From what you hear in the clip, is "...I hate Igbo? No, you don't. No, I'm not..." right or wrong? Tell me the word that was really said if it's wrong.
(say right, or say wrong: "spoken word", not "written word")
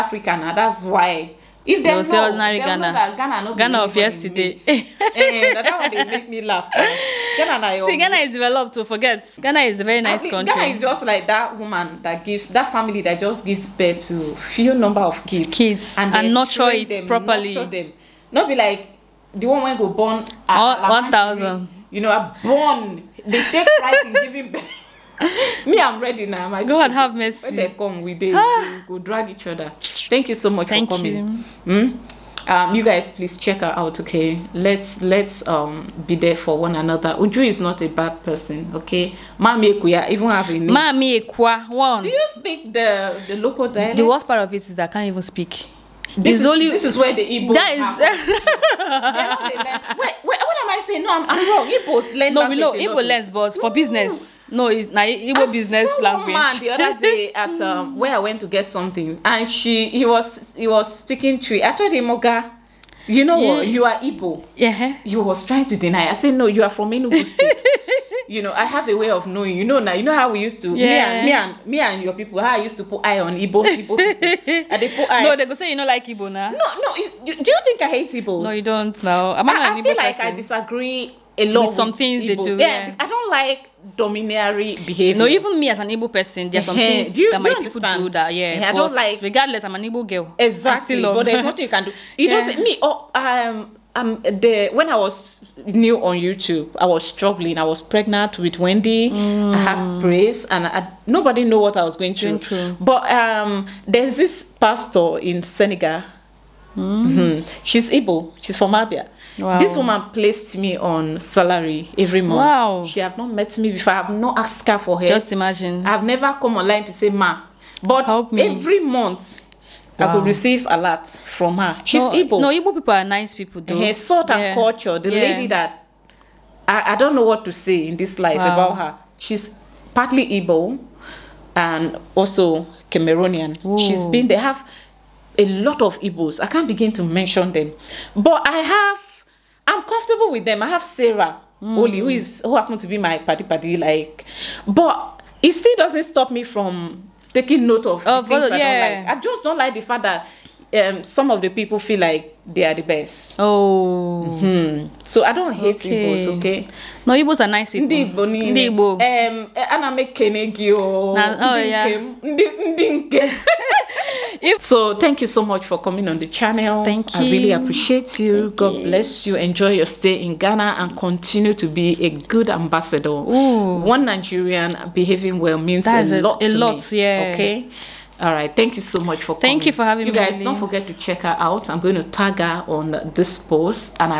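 right.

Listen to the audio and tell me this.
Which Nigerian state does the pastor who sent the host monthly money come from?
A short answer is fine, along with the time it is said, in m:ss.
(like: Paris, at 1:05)
Abia, at 1:48.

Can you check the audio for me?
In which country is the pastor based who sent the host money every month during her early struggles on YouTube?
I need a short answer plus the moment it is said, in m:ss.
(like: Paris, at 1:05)
Senegal, at 1:45.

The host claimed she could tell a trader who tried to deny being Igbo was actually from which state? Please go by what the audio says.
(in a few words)
Enugu State.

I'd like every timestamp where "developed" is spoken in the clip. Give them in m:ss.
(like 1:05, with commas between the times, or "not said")
0:08.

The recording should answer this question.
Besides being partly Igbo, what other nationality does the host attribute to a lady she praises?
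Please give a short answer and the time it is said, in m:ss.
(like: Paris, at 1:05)
Cameroonian, at 2:12.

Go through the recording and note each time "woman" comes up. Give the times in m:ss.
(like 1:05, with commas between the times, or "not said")
0:11, 1:49.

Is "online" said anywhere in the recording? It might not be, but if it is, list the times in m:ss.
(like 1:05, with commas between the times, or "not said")
1:56.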